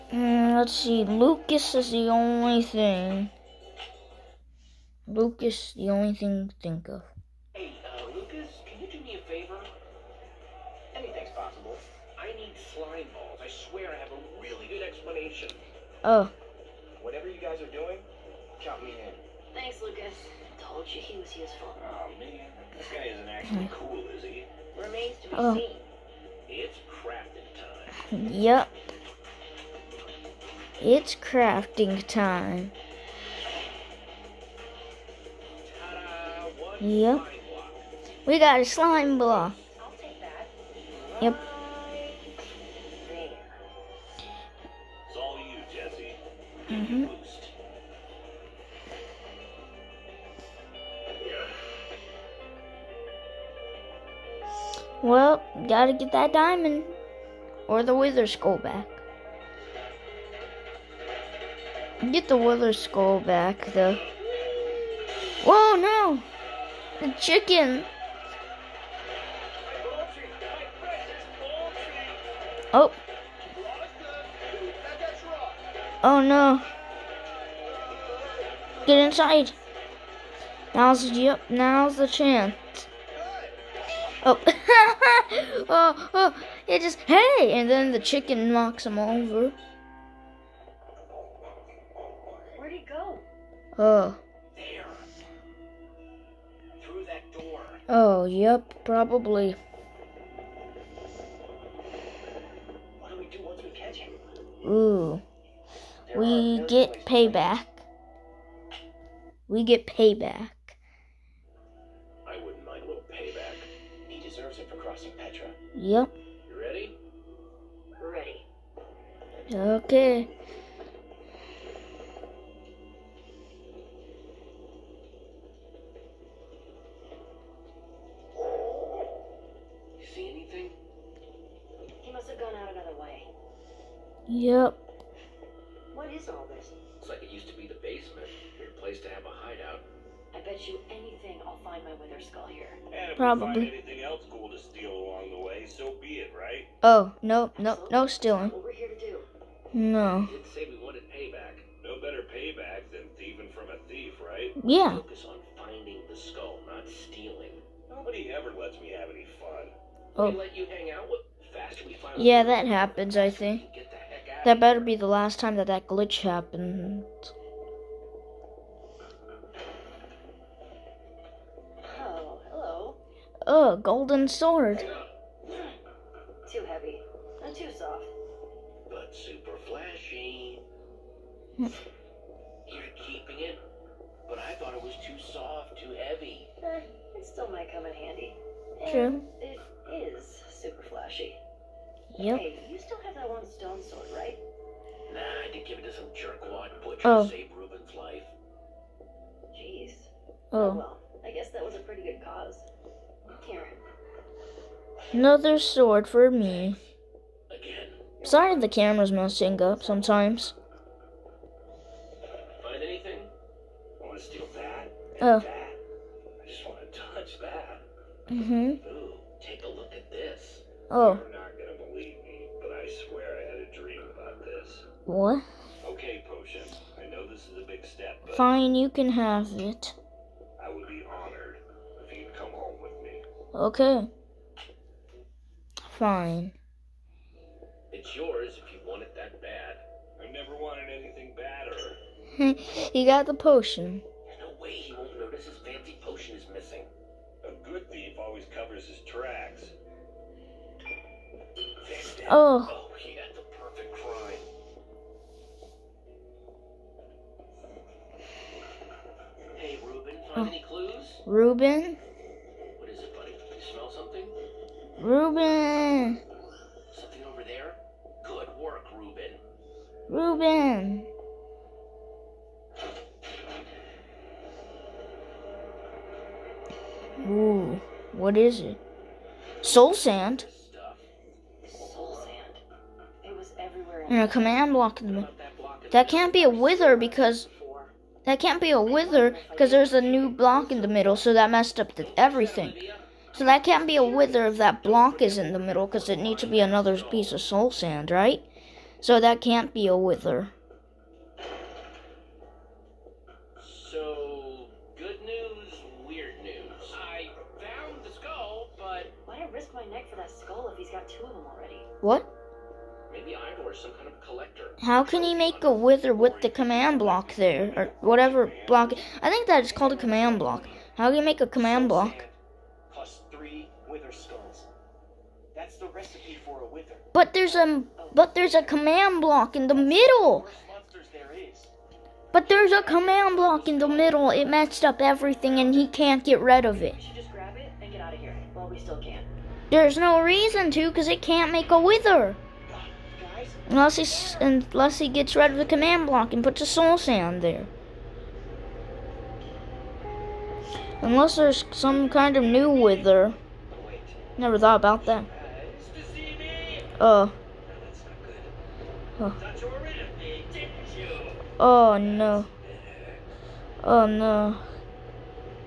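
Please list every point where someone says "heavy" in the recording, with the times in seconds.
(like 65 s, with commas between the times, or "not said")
176 s, 186 s.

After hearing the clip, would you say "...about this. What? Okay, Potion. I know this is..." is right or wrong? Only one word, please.
right.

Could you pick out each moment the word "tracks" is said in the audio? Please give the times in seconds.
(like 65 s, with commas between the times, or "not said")
249 s.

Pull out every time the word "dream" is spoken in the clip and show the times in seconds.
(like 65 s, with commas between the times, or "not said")
223 s.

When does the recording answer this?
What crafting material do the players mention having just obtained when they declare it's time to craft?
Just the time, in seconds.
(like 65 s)
38 s.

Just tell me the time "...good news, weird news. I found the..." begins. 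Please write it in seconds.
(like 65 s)
304 s.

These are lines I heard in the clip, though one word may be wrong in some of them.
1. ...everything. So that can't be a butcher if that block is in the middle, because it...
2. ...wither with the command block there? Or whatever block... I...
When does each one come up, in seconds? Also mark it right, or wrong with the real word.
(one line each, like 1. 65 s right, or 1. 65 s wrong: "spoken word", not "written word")
1. 292 s wrong: "wither", not "butcher"
2. 315 s right.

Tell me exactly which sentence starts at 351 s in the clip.
Unless there's some kind of new wither.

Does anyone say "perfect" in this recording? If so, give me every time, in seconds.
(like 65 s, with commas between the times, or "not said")
253 s.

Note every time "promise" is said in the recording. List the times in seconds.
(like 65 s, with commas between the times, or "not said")
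140 s.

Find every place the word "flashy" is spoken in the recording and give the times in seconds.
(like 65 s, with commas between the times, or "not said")
179 s, 190 s.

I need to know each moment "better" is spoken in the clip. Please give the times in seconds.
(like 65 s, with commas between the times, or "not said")
151 s, 164 s.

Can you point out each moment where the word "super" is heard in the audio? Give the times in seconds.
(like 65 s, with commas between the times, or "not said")
179 s, 190 s.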